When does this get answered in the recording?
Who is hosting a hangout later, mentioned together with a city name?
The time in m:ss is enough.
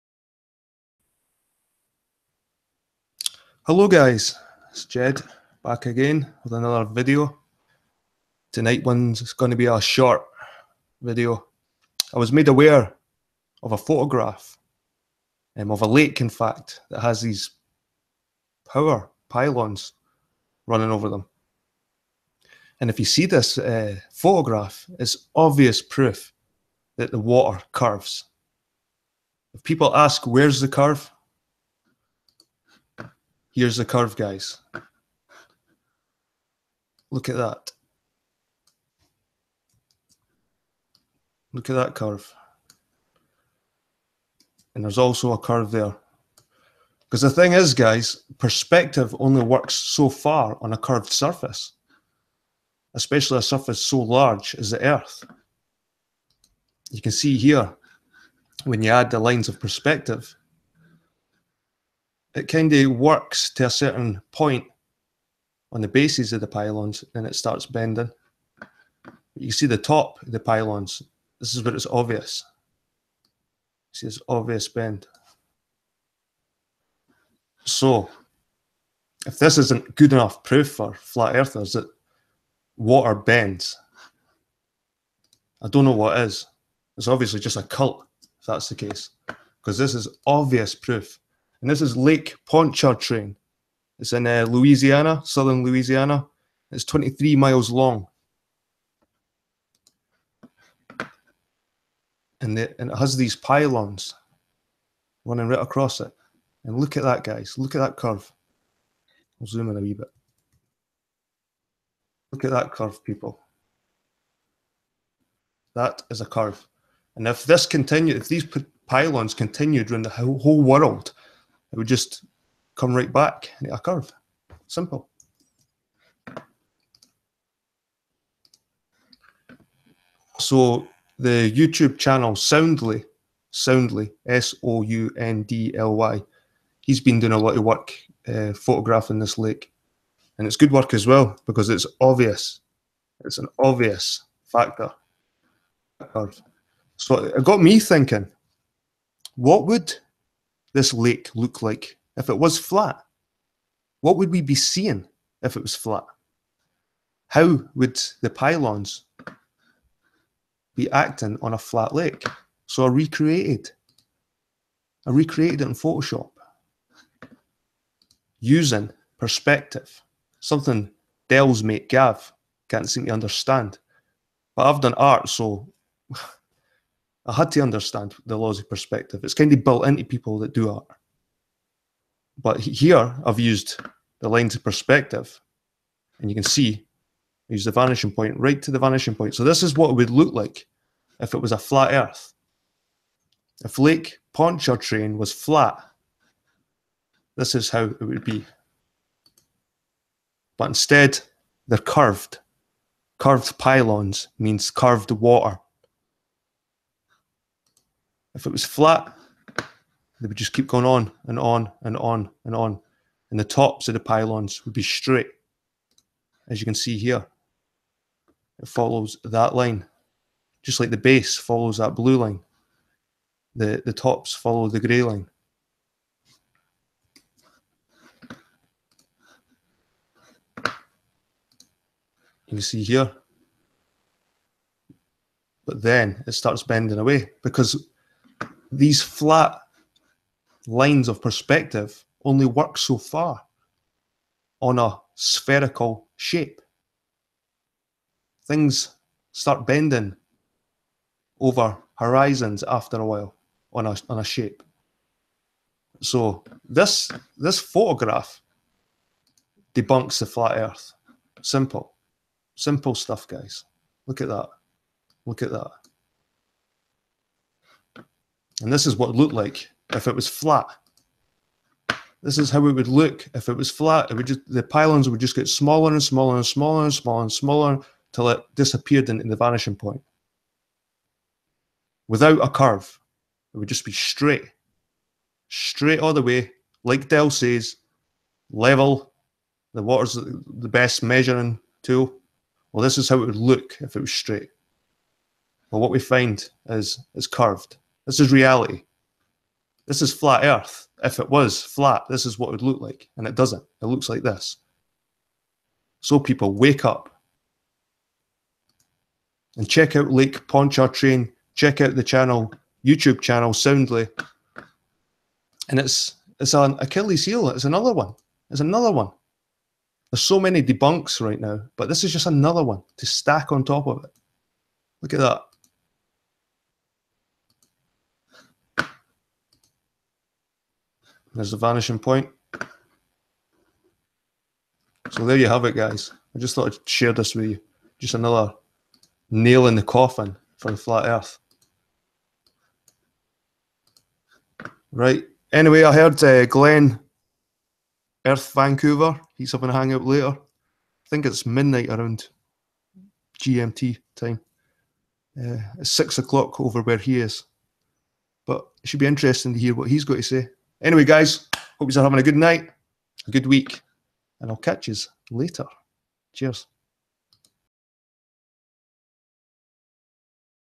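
5:46.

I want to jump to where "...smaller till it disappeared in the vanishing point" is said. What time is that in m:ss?
4:37.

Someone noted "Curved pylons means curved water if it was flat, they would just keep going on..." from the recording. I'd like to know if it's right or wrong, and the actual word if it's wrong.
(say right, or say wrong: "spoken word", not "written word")
right.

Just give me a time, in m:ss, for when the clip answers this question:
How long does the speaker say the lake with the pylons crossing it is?
1:36.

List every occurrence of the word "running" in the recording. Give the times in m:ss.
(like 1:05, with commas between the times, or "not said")
0:20, 1:45.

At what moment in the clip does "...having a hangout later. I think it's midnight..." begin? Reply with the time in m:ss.
5:49.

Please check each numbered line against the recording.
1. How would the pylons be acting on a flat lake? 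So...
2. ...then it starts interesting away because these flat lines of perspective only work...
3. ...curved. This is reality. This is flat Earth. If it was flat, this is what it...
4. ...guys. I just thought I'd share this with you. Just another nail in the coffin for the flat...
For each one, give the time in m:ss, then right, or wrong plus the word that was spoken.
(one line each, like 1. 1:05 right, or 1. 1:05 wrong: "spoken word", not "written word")
1. 2:37 right
2. 3:55 wrong: "bending", not "interesting"
3. 4:57 right
4. 5:35 right.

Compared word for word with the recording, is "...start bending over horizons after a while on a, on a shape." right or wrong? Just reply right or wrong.
right.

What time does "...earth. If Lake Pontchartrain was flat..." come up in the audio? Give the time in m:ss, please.
3:11.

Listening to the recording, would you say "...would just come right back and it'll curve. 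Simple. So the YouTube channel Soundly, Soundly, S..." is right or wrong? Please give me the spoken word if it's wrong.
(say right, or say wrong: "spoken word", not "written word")
right.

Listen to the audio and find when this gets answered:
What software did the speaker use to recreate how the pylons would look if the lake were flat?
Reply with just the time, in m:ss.
2:45.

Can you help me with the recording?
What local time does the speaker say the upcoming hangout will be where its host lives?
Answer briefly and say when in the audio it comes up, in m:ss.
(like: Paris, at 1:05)
6 o'clock, at 5:55.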